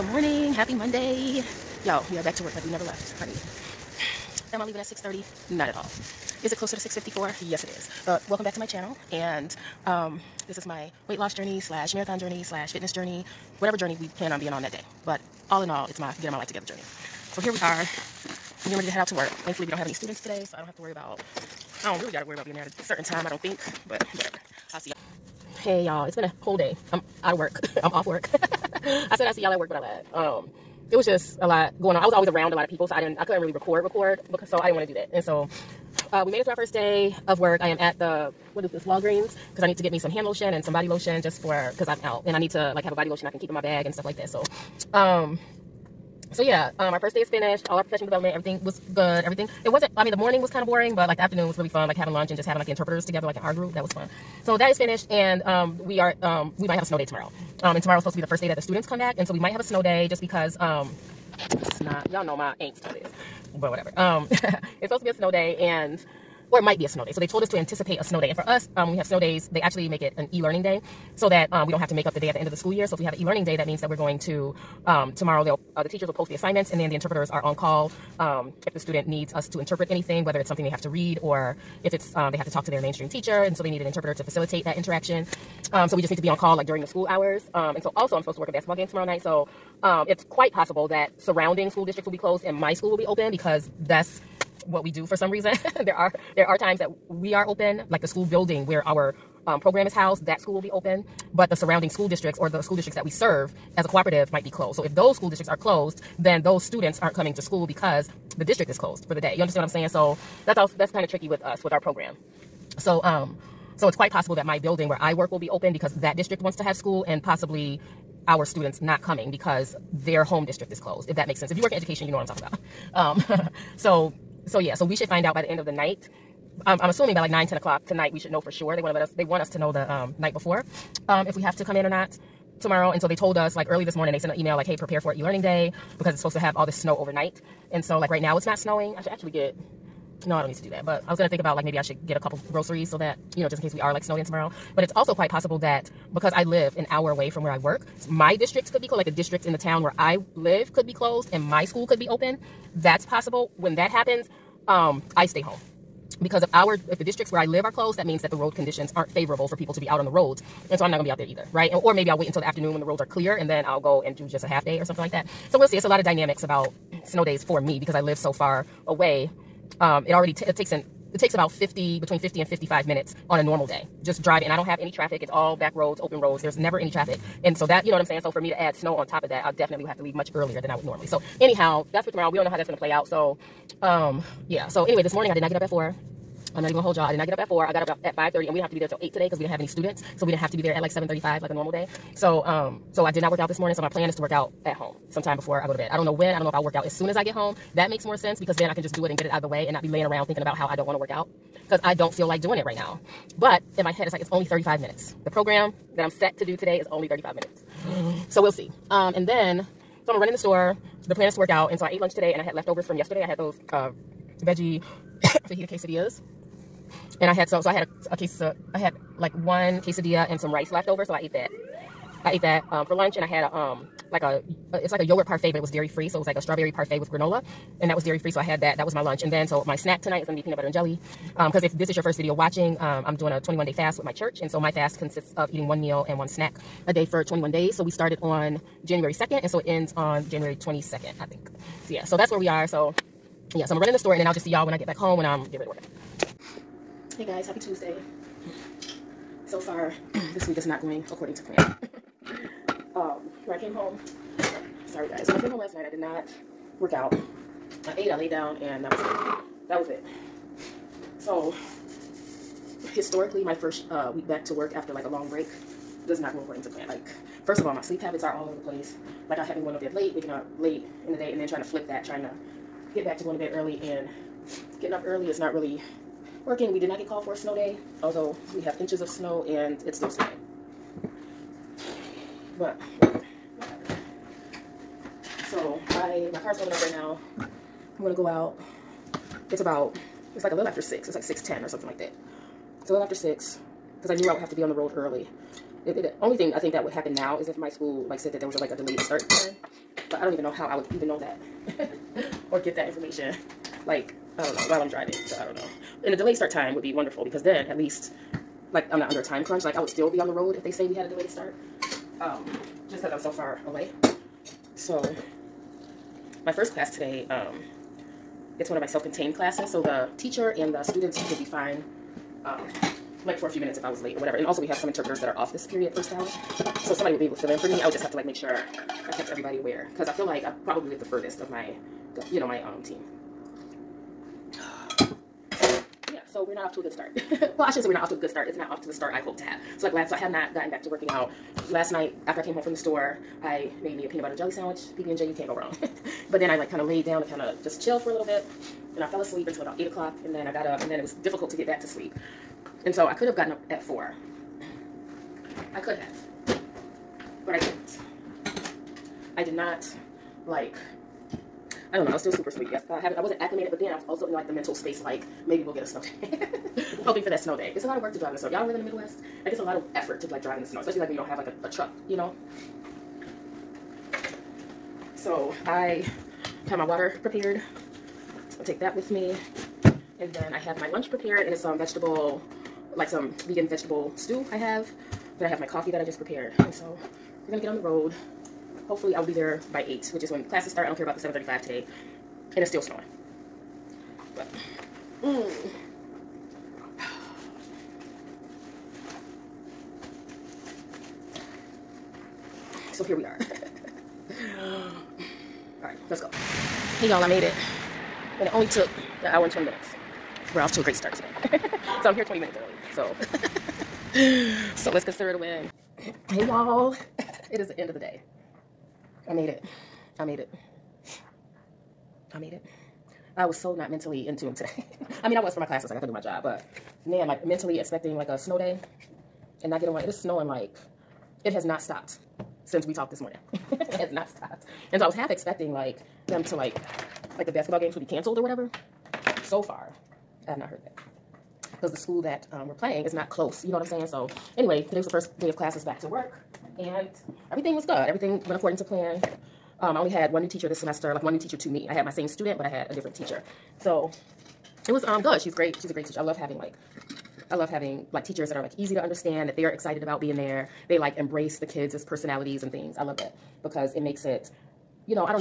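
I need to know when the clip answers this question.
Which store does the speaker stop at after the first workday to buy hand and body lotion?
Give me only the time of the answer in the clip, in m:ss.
0:38.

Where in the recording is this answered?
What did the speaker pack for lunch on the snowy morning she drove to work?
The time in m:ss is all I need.
6:23.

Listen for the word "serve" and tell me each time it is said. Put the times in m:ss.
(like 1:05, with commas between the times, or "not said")
1:43.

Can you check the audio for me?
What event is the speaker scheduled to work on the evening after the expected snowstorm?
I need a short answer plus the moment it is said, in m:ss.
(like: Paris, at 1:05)
basketball game, at 1:28.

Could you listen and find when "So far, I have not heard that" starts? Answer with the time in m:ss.
7:19.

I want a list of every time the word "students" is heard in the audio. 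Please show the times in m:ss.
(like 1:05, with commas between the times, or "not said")
0:19, 0:58, 1:18, 1:46, 1:58, 3:09, 5:20, 7:32.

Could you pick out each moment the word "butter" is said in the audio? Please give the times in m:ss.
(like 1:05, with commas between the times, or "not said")
3:50, 5:44.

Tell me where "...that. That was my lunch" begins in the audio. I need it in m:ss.
3:48.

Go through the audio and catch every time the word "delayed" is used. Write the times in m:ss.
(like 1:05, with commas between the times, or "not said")
4:58, 5:06, 5:11.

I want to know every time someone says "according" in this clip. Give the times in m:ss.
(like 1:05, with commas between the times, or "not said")
4:11, 4:26, 7:28.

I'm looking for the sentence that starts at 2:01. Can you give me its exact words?
If you work in education, you know what I'm talking about.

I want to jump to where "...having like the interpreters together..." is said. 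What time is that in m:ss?
0:52.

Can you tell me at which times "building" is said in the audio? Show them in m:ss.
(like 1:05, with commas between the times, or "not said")
1:38, 1:54.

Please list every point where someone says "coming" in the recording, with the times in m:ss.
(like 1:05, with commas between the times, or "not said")
1:47, 1:59.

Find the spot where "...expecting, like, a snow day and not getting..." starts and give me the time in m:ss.
7:07.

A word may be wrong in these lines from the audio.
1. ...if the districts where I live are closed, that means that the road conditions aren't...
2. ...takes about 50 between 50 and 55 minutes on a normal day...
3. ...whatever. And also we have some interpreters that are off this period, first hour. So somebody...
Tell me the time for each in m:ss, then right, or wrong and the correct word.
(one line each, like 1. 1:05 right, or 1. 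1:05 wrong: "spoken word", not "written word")
1. 2:36 right
2. 2:51 right
3. 5:24 right.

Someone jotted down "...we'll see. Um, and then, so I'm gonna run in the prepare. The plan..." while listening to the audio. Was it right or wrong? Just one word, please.
wrong.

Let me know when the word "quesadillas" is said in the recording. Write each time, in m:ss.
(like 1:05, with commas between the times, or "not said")
3:35, 3:39.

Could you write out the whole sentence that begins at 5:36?
So we're not off to a good start.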